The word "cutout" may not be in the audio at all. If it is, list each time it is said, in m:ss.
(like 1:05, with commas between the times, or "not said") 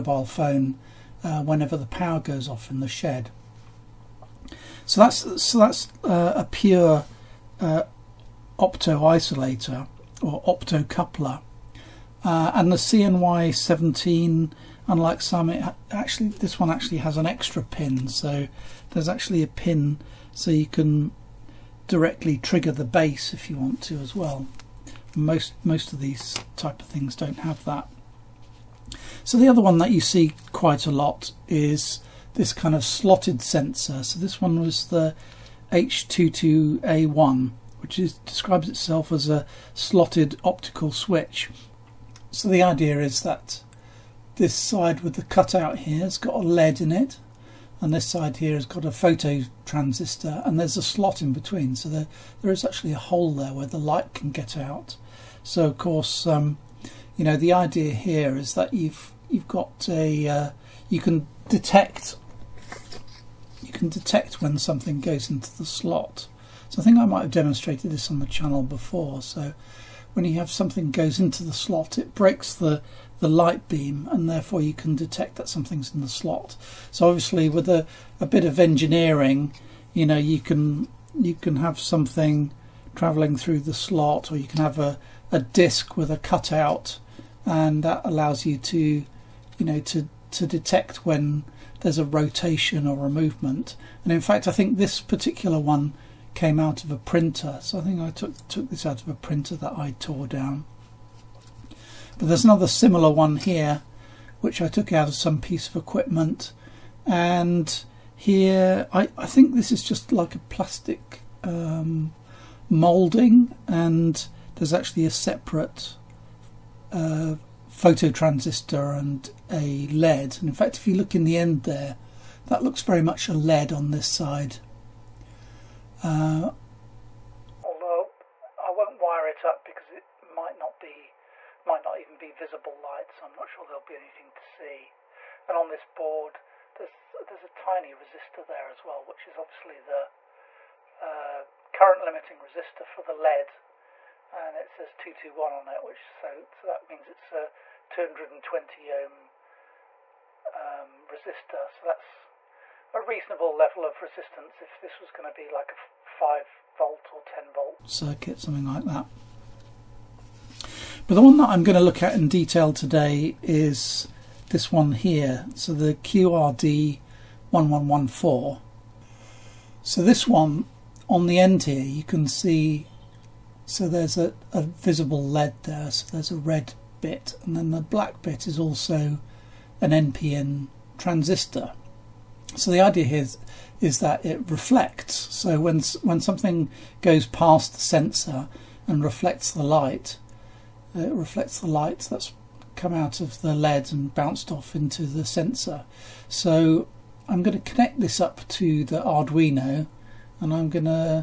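0:45, 1:26.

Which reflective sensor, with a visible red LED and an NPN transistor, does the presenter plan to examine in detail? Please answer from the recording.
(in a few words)
QRD1114.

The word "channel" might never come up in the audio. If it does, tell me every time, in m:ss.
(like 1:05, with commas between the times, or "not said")
1:08.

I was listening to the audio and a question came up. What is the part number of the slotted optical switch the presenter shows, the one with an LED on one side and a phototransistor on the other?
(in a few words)
H22A1.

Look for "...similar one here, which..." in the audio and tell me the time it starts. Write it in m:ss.
1:42.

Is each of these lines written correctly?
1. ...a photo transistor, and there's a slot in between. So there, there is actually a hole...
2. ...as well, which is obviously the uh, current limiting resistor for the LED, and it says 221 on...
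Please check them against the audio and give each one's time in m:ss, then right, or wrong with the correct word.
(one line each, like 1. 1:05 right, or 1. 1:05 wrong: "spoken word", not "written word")
1. 0:48 right
2. 2:18 right.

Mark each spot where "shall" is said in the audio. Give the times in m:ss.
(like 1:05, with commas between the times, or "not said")
not said.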